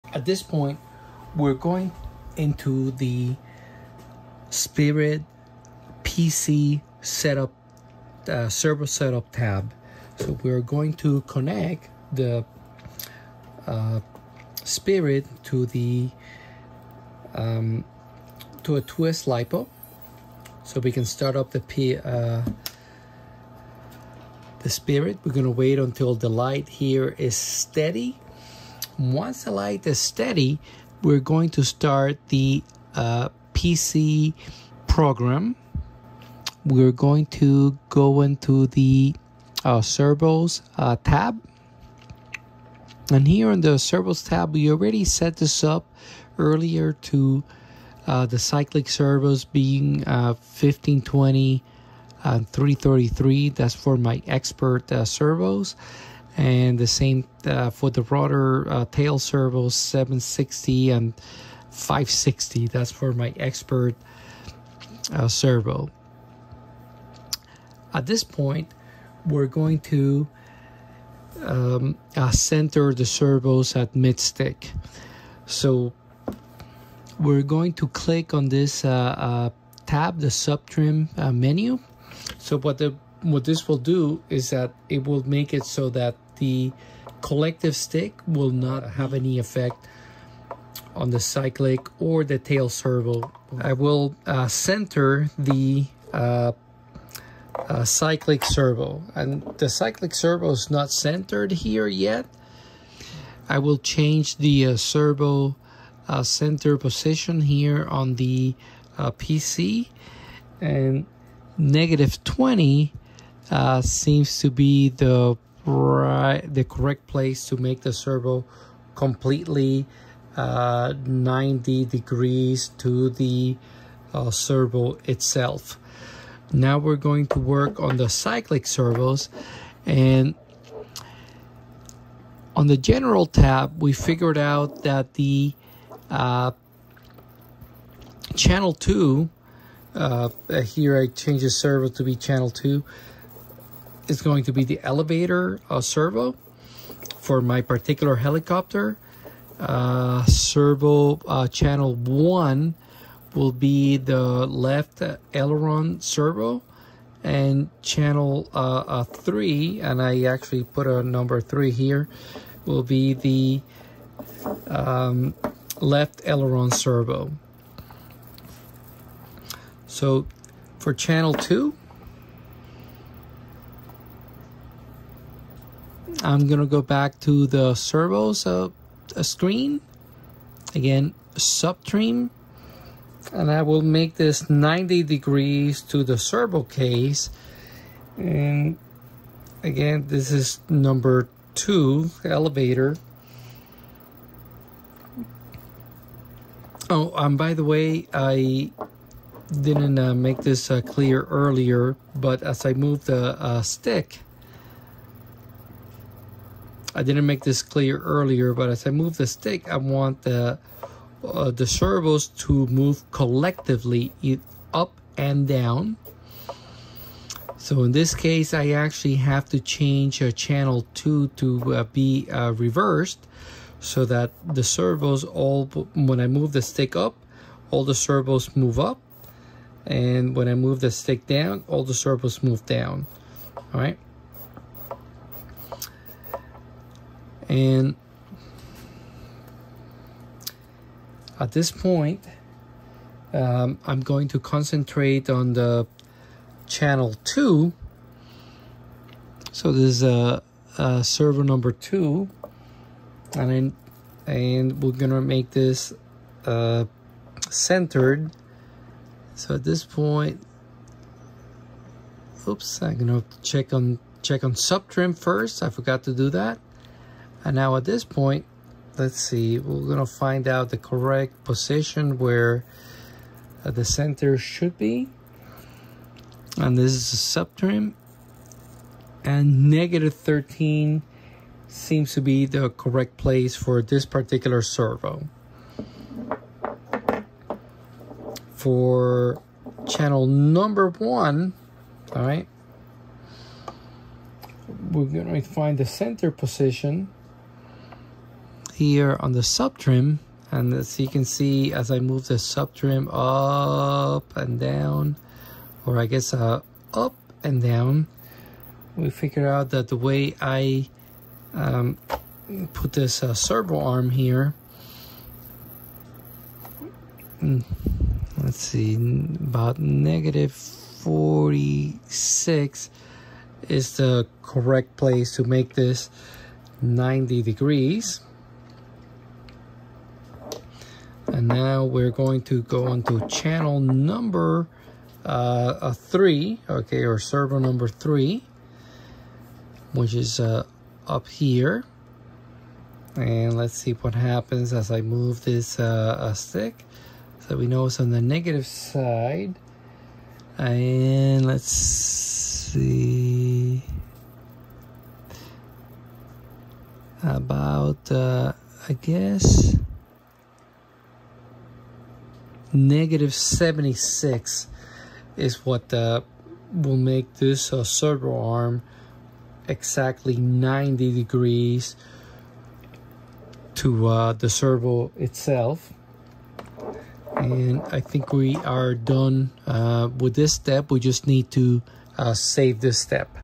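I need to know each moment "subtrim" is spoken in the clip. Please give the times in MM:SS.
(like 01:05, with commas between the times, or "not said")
03:01, 04:24, 04:37.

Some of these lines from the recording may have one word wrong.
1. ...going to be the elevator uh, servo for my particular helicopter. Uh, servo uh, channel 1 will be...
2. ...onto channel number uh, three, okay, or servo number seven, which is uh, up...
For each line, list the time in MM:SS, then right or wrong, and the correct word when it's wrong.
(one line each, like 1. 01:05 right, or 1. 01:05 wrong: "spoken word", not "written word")
1. 02:24 right
2. 05:32 wrong: "three", not "seven".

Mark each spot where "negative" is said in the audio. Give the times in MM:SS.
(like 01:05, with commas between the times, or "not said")
01:51, 04:39, 05:19, 05:48, 06:02.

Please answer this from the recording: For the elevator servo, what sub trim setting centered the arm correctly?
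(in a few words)
-13.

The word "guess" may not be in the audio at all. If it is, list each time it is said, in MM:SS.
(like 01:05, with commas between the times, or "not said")
05:06, 05:58.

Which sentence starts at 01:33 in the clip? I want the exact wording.
I will uh, center the uh, uh, cyclic servo and the cyclic servo is not centered here yet.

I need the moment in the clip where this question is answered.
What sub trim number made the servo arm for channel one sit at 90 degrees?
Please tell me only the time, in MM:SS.
05:19.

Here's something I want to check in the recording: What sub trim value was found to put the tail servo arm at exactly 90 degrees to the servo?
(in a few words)
-20.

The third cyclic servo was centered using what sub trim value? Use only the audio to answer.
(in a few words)
-76.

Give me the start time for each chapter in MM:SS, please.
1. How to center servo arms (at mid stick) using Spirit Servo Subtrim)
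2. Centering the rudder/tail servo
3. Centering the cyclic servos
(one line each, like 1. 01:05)
1. 01:06
2. 01:32
3. 02:05.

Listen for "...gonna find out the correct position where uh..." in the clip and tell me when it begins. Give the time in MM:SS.
04:29.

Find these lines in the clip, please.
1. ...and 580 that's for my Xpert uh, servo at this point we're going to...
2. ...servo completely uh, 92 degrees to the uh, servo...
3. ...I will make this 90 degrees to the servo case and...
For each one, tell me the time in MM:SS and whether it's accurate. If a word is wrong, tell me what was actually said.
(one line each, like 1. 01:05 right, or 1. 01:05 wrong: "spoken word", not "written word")
1. 01:00 wrong: "560", not "580"
2. 01:57 wrong: "90", not "92"
3. 03:03 right.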